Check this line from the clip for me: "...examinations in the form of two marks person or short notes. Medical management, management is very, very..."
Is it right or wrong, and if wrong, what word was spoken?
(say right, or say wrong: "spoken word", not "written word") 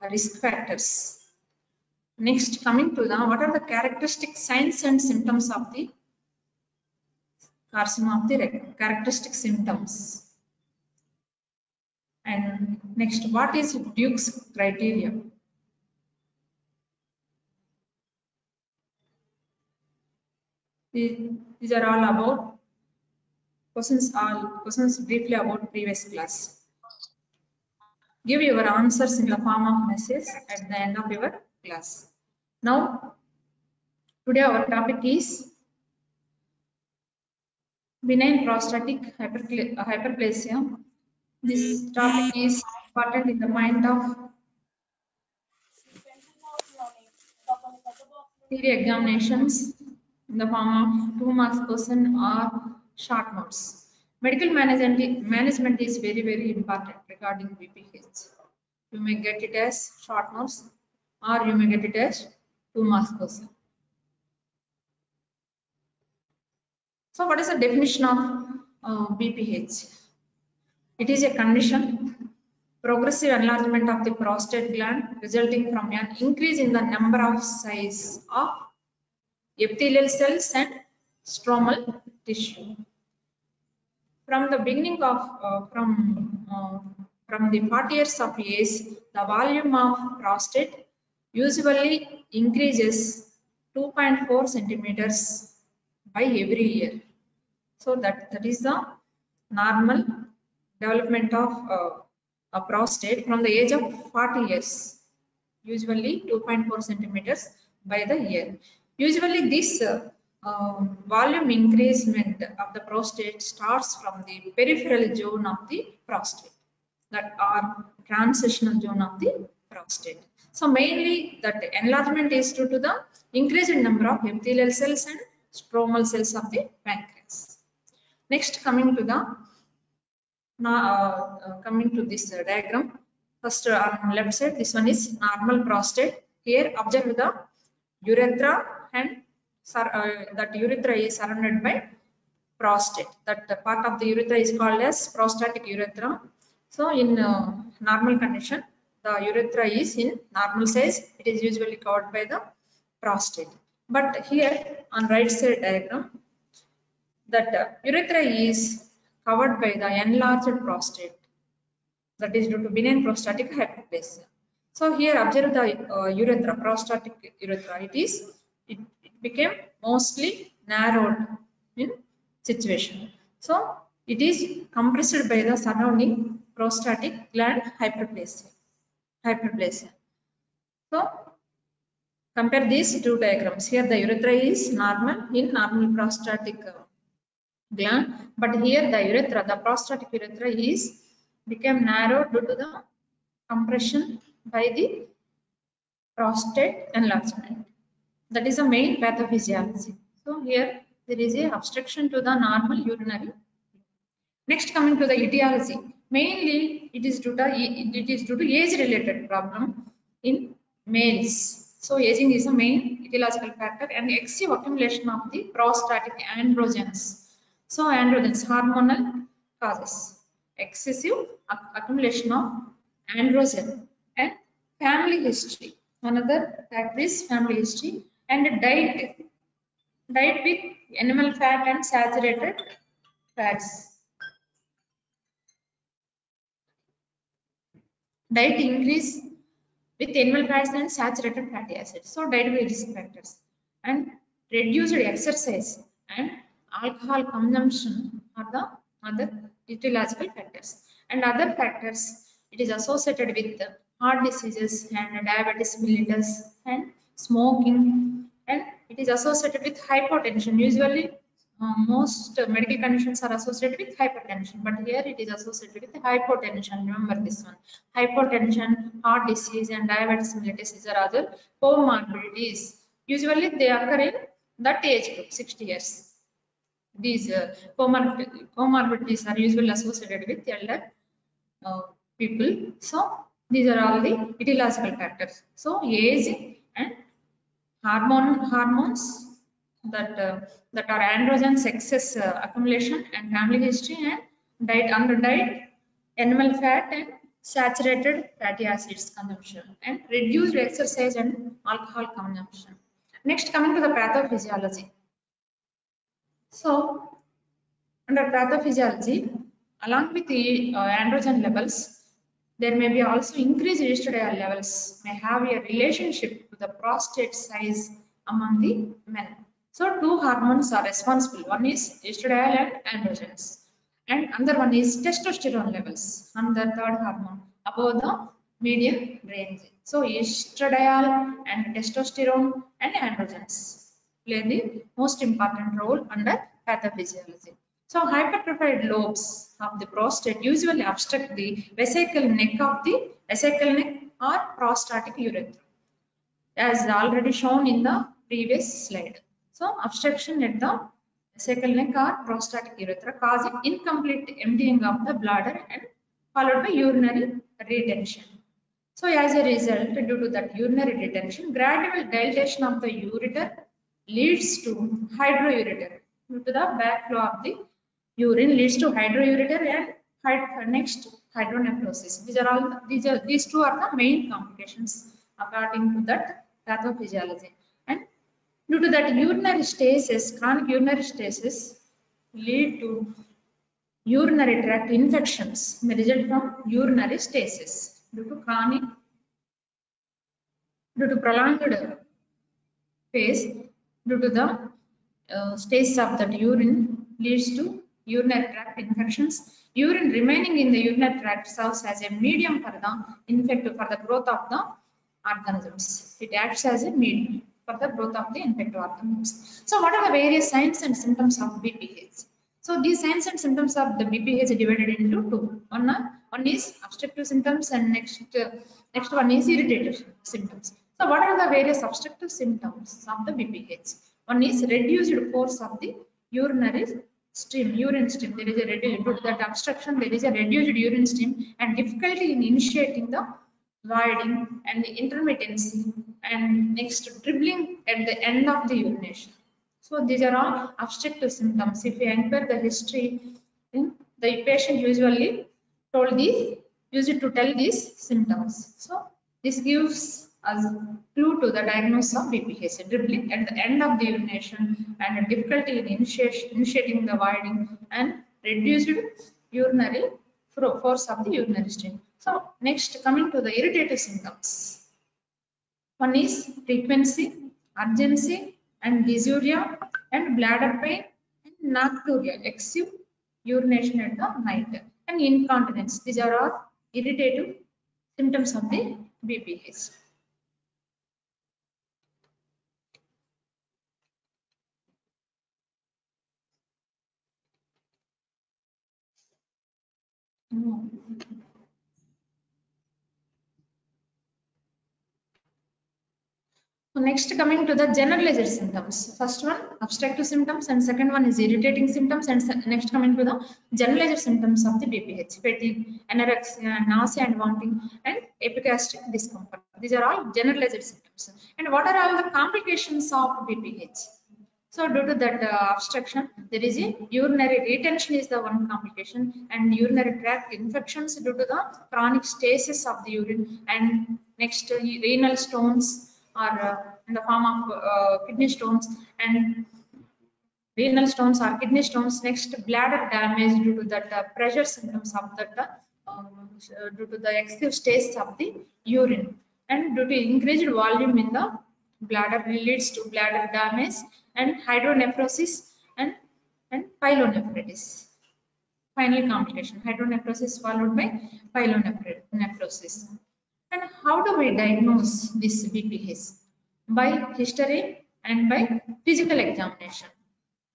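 right.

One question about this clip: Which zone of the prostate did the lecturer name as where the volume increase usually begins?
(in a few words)
peripheral zone.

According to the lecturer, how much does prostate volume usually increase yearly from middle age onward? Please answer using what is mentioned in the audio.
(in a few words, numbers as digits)
2.4 centimeters.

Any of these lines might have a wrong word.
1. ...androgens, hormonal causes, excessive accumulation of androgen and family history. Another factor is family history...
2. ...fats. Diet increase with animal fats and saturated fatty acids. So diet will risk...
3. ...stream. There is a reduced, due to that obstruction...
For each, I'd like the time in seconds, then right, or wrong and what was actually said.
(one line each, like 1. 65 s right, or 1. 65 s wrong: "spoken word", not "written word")
1. 217 s right
2. 233 s right
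3. 428 s right.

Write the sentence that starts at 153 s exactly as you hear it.
But here on right side diagram, that urethra is covered by the enlarged prostate that is due to benign prostatic hyperplasia.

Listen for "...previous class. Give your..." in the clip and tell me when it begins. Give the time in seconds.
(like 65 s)
25 s.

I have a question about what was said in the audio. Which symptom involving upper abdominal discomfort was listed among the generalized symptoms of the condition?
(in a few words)
epigastric discomfort.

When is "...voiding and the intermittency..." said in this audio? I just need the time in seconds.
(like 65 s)
433 s.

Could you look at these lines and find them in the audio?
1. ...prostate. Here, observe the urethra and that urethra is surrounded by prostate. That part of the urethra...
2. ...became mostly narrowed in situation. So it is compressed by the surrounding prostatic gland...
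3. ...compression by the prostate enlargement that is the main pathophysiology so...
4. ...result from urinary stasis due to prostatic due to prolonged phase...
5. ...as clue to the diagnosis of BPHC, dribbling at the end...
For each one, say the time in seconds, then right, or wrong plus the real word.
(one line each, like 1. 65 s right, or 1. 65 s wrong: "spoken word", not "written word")
1. 135 s right
2. 169 s right
3. 193 s right
4. 385 s wrong: "chronic", not "prostatic"
5. 450 s right.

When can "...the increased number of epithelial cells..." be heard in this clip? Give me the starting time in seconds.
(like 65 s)
122 s.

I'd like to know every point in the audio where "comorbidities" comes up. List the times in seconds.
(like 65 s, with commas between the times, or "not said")
271 s, 277 s.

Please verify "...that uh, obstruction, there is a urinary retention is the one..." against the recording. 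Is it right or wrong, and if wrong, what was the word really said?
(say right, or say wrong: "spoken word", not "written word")
right.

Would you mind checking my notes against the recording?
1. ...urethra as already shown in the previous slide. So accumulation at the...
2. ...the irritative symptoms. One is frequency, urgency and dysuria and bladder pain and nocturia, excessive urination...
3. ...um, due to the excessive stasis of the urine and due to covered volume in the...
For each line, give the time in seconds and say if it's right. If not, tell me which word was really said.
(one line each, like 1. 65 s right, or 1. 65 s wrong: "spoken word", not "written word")
1. 345 s wrong: "obstruction", not "accumulation"
2. 463 s right
3. 536 s wrong: "increased", not "covered".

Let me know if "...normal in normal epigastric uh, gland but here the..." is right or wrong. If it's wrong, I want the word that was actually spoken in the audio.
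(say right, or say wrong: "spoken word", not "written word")
wrong: "prostatic", not "epigastric".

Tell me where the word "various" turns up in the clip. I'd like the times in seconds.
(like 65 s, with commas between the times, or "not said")
410 s, 421 s.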